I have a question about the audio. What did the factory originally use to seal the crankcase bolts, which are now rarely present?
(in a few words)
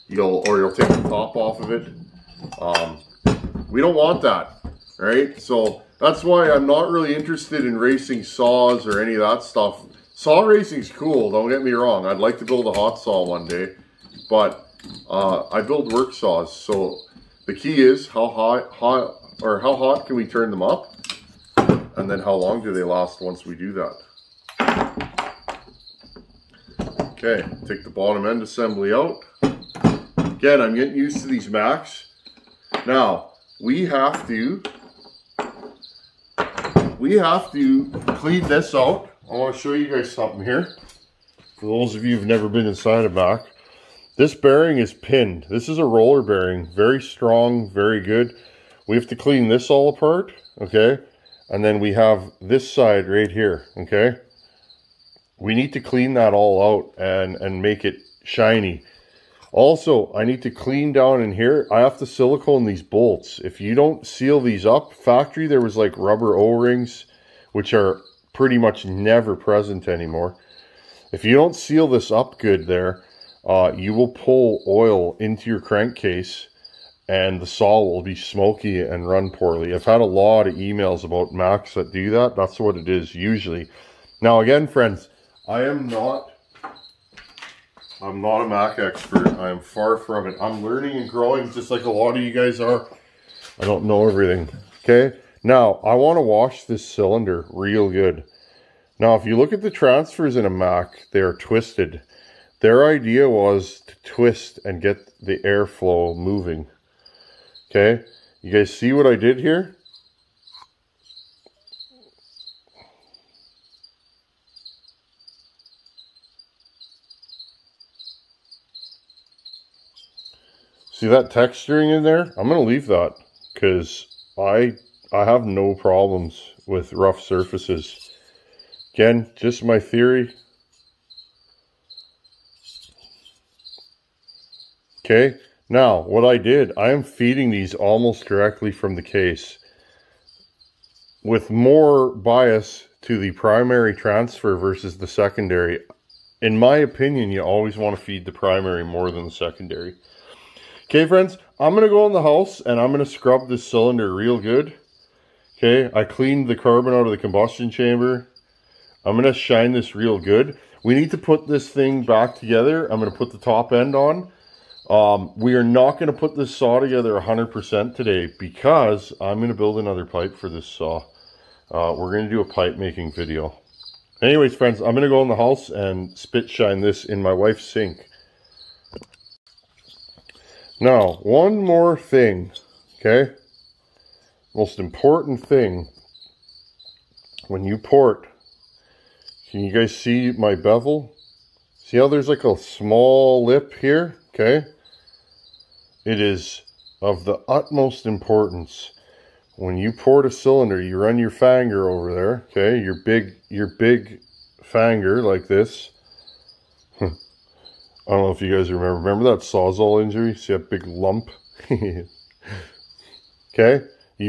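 Rubber O-rings.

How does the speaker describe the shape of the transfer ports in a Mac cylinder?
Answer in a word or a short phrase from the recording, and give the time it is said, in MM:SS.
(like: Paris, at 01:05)
Twisted, at 01:41.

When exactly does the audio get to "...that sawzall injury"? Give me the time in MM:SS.
03:29.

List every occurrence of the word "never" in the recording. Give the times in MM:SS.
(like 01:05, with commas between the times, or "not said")
00:42, 01:08.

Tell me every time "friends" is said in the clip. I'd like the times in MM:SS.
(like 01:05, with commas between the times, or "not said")
01:24, 02:31, 02:54.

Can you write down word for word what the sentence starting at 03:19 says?
When you pour the cylinder, you run your finger over there, okay?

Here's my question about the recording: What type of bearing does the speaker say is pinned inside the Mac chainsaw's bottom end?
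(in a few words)
Roller bearing.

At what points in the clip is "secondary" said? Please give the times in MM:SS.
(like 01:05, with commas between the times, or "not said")
02:25, 02:29.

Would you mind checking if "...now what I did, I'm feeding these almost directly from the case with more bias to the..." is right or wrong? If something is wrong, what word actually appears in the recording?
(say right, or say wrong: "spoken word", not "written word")
right.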